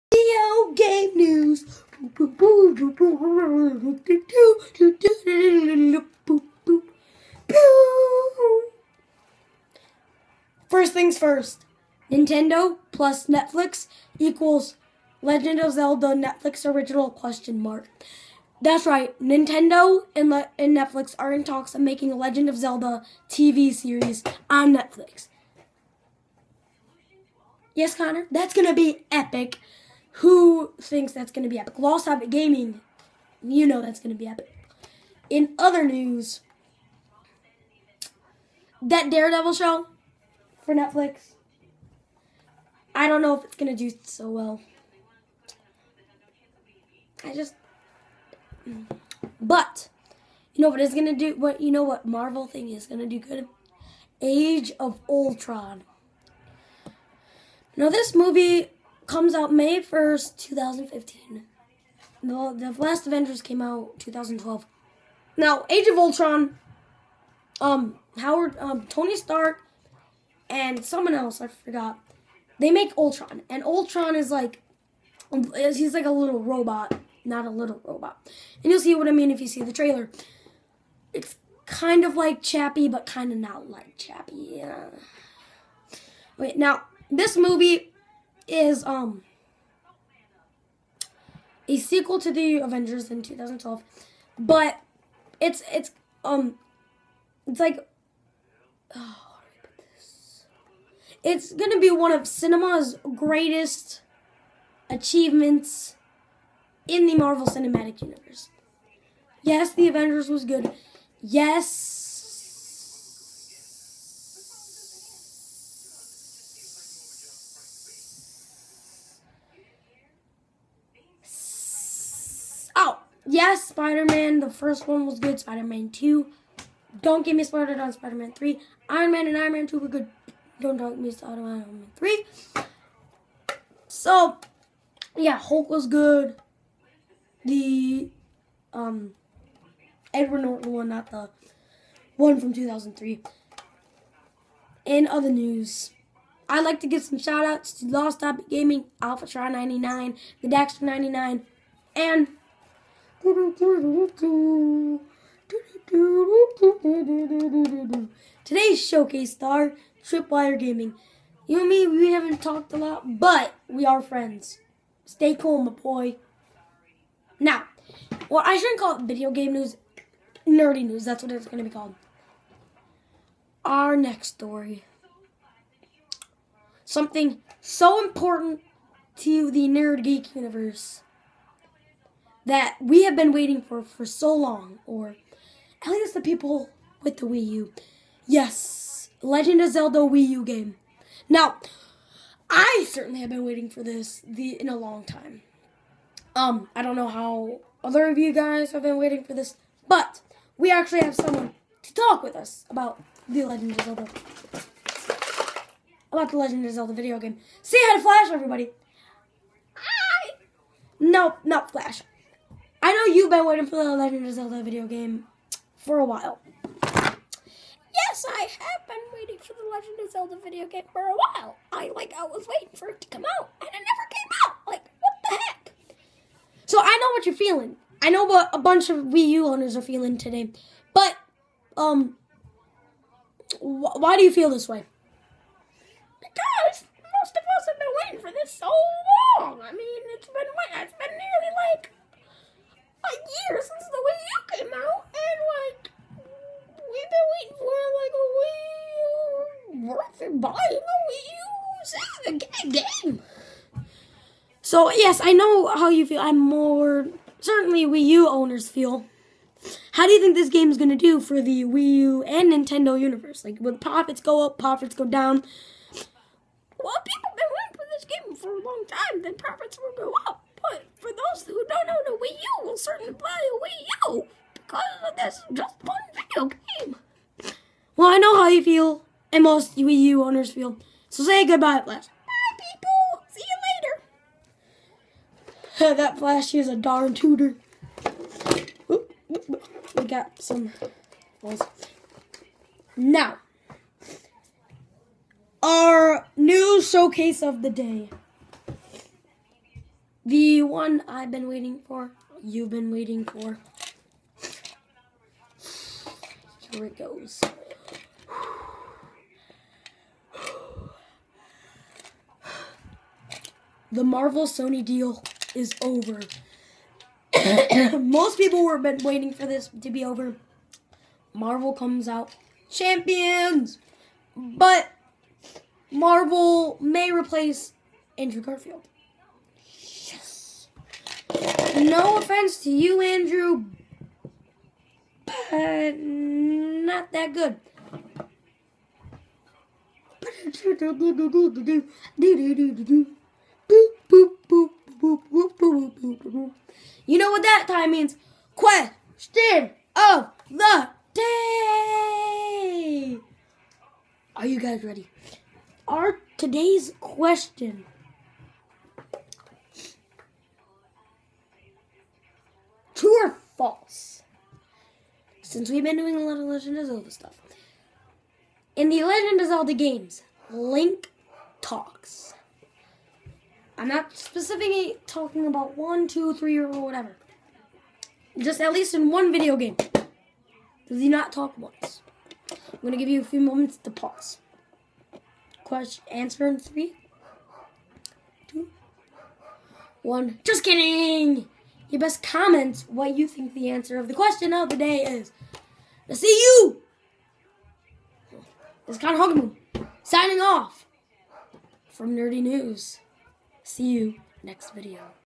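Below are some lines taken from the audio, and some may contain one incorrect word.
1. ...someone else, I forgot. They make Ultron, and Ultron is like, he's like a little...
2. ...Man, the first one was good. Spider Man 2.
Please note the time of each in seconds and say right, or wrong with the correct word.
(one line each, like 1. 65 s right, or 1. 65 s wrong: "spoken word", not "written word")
1. 70 s right
2. 124 s right.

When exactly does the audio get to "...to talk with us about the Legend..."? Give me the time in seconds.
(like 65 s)
201 s.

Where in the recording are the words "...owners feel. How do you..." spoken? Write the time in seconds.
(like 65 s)
258 s.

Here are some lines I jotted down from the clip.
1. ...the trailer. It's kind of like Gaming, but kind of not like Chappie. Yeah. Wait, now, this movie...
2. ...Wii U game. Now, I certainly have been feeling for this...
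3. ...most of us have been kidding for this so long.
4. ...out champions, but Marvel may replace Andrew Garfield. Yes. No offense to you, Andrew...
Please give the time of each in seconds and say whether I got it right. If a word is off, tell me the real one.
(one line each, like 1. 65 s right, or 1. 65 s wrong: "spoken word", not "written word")
1. 79 s wrong: "Chappie", not "Gaming"
2. 189 s wrong: "waiting", not "feeling"
3. 237 s wrong: "waiting", not "kidding"
4. 322 s right.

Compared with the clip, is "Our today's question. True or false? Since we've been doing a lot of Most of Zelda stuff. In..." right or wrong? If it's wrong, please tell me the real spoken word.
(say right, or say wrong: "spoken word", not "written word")
wrong: "Legend", not "Most".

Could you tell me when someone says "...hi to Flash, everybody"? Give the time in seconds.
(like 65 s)
207 s.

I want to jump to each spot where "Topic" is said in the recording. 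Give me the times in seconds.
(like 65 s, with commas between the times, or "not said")
148 s.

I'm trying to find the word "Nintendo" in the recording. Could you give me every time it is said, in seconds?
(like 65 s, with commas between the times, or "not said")
12 s, 19 s, 262 s.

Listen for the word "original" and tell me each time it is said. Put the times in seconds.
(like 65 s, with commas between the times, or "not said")
16 s.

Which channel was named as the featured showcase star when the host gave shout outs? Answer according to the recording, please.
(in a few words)
Tripwire Gaming.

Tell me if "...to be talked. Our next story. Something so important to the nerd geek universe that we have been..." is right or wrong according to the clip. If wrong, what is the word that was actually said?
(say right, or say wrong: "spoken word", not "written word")
wrong: "called", not "talked".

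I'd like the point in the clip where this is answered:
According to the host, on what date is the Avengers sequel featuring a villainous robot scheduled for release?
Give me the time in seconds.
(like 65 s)
59 s.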